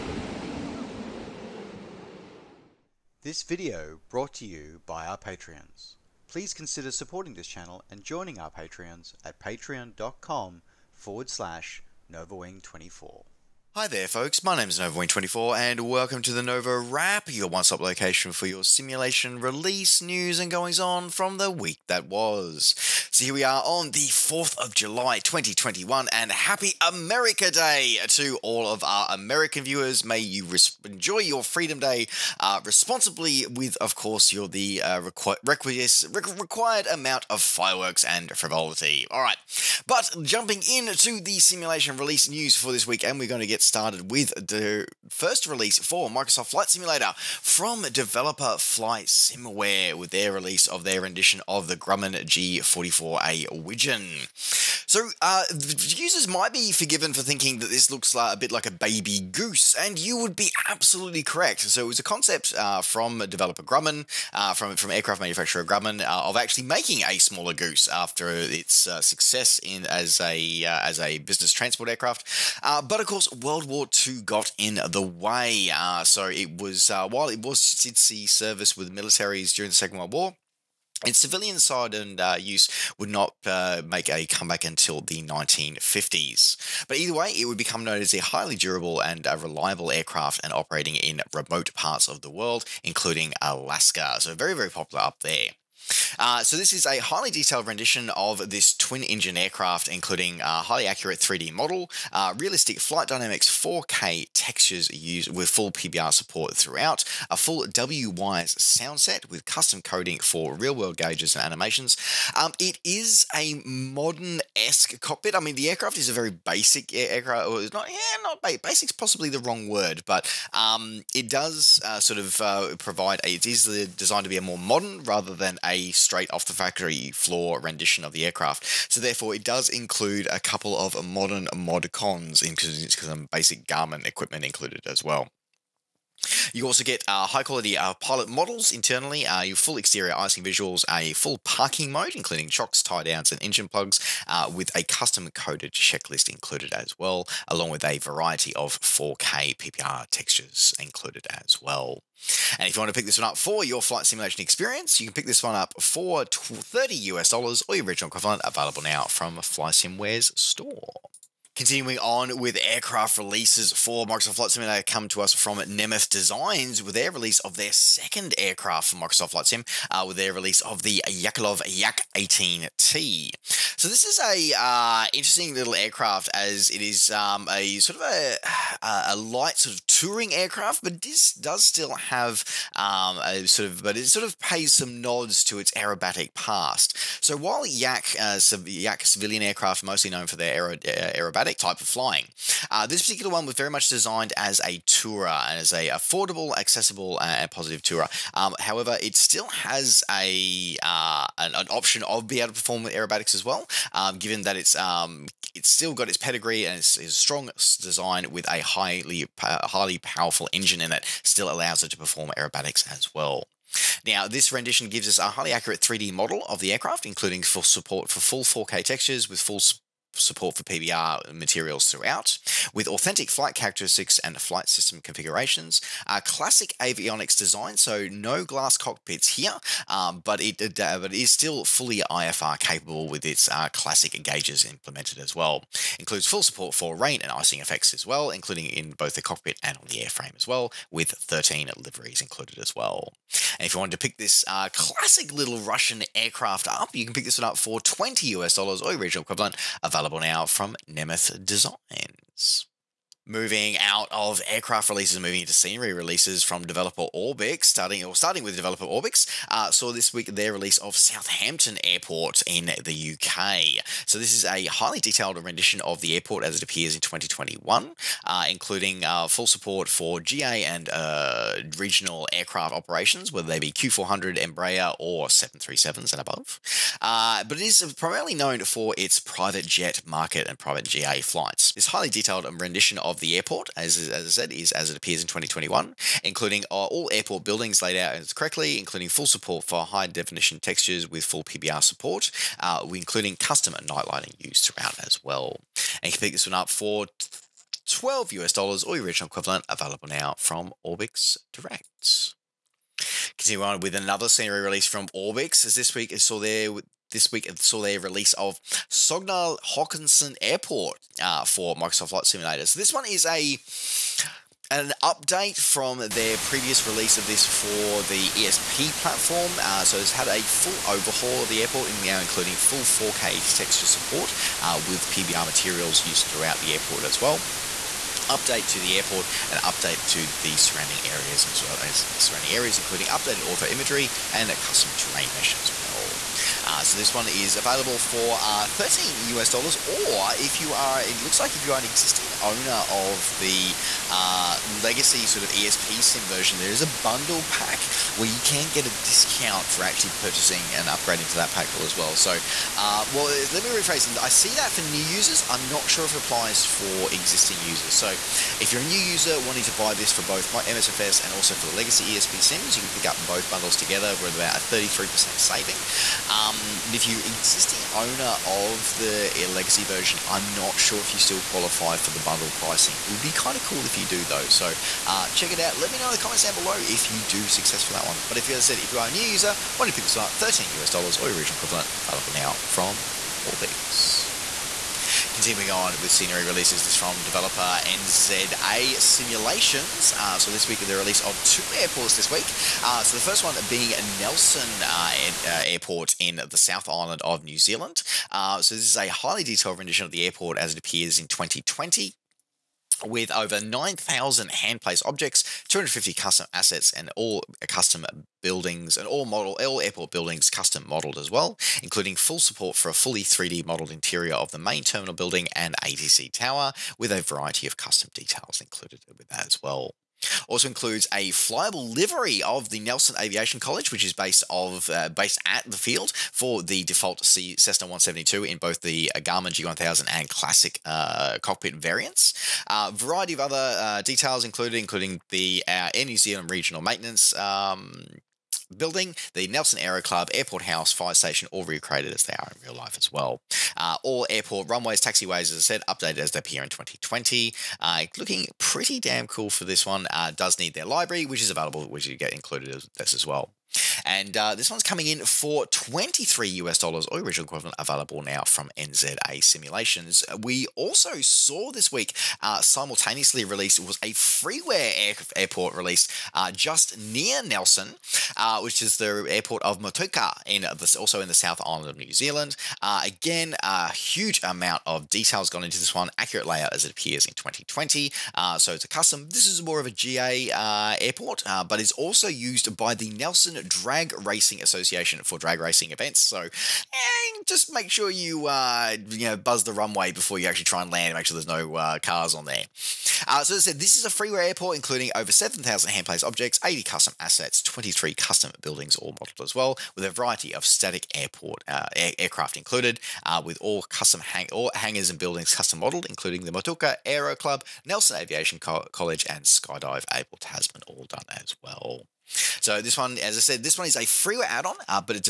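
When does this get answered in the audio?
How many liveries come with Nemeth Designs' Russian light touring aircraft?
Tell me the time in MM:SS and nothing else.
04:01.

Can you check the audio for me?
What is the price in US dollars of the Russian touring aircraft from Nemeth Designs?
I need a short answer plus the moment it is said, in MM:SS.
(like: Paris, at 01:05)
$20, at 04:07.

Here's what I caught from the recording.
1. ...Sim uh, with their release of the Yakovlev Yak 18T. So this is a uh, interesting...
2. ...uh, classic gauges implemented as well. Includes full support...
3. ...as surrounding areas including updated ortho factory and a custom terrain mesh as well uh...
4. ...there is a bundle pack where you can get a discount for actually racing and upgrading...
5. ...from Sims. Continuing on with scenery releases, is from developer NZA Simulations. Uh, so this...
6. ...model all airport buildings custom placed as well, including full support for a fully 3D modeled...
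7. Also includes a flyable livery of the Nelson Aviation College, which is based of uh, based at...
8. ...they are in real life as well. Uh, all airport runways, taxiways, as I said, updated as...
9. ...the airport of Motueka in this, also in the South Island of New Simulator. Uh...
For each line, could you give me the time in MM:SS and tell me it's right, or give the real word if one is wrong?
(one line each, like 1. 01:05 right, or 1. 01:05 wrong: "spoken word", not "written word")
1. 02:49 right
2. 03:53 right
3. 05:31 wrong: "imagery", not "factory"
4. 05:46 wrong: "purchasing", not "racing"
5. 06:22 wrong: "Orbx", not "Sims"
6. 06:49 wrong: "modeled", not "placed"
7. 07:00 right
8. 07:22 right
9. 07:48 wrong: "Zealand", not "Simulator".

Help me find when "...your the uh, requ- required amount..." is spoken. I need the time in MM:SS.
00:34.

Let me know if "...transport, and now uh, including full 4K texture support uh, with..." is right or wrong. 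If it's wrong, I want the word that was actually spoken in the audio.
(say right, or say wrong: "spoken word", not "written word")
wrong: "airport", not "transport".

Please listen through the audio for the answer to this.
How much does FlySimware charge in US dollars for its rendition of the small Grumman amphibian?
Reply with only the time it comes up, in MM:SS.
02:36.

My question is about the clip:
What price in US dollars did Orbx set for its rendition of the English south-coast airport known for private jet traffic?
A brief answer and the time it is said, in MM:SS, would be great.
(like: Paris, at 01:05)
$12, at 04:57.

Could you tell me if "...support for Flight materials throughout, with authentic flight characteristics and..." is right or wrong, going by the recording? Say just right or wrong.
wrong.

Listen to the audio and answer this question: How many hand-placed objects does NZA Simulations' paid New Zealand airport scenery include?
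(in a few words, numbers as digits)
over 9,000.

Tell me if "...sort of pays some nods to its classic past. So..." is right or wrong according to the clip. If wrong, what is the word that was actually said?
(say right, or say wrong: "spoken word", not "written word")
wrong: "aerobatic", not "classic".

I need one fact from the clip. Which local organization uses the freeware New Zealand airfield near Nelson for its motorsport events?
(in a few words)
Nelson Drag Racing Association.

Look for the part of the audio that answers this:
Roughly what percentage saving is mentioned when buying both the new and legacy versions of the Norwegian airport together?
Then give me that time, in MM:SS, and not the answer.
06:04.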